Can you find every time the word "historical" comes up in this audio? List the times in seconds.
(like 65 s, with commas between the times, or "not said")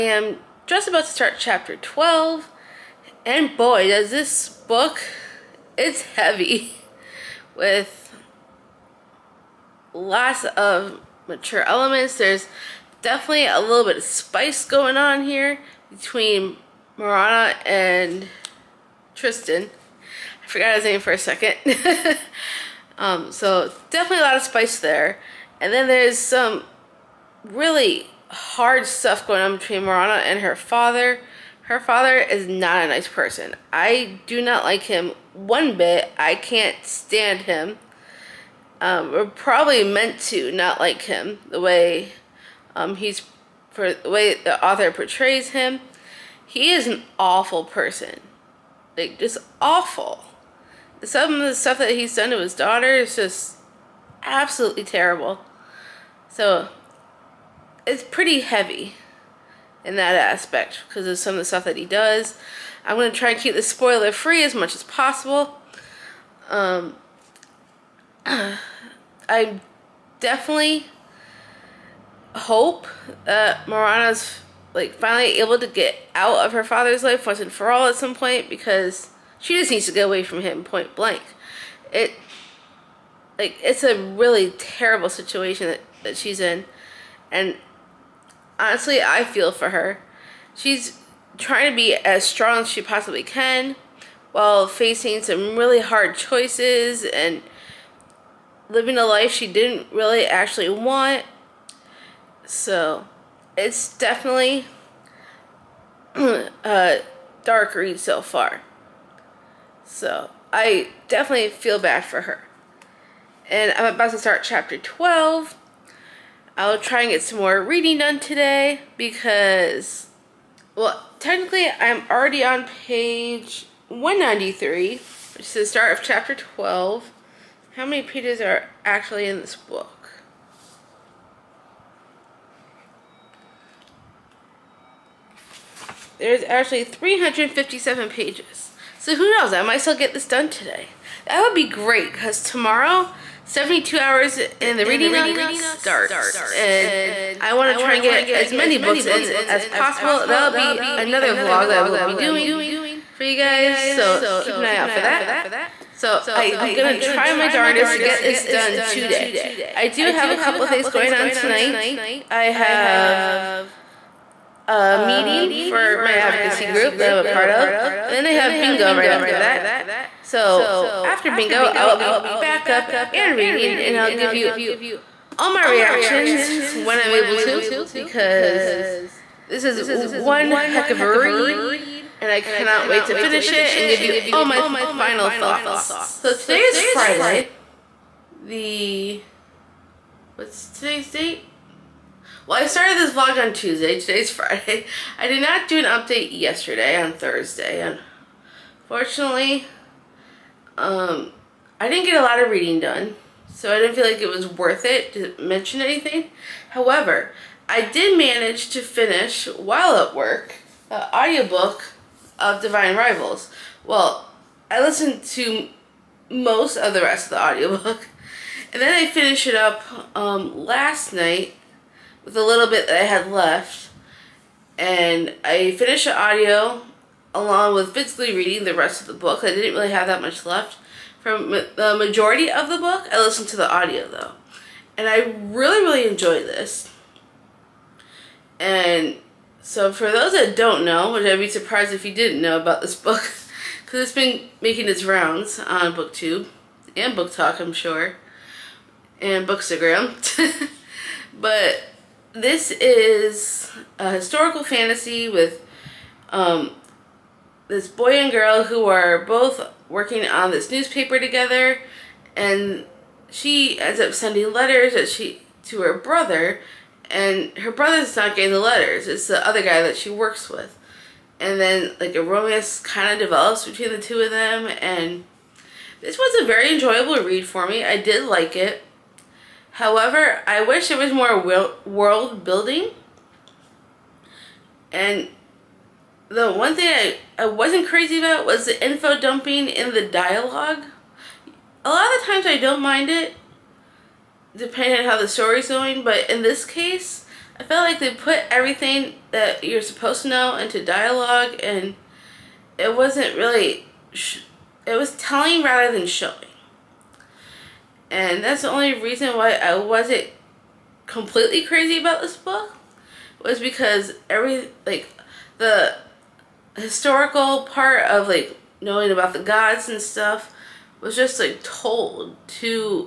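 254 s, 316 s.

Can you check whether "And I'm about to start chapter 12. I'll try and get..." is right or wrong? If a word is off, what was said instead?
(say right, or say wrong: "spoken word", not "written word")
right.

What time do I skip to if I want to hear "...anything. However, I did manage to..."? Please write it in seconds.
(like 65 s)
205 s.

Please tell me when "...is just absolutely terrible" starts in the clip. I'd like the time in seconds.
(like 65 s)
52 s.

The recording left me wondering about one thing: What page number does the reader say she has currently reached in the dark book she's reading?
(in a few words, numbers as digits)
193.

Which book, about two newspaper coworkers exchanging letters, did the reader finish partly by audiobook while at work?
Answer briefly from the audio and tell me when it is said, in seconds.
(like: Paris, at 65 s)
Divine Rivals, at 212 s.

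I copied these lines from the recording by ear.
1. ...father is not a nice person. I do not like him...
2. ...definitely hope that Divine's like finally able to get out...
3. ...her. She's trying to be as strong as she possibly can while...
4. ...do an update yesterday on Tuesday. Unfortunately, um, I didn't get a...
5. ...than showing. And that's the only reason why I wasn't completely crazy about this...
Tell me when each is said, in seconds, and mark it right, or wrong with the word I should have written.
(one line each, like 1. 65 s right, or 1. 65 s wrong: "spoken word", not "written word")
1. 31 s right
2. 70 s wrong: "Morana", not "Divine"
3. 89 s right
4. 195 s wrong: "Thursday", not "Tuesday"
5. 305 s right.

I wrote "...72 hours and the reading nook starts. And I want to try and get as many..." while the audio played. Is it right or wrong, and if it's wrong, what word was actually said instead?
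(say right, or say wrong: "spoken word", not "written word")
right.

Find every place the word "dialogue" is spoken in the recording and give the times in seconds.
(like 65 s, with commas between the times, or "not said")
290 s, 300 s.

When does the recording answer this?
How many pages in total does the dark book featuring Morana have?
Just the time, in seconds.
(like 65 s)
136 s.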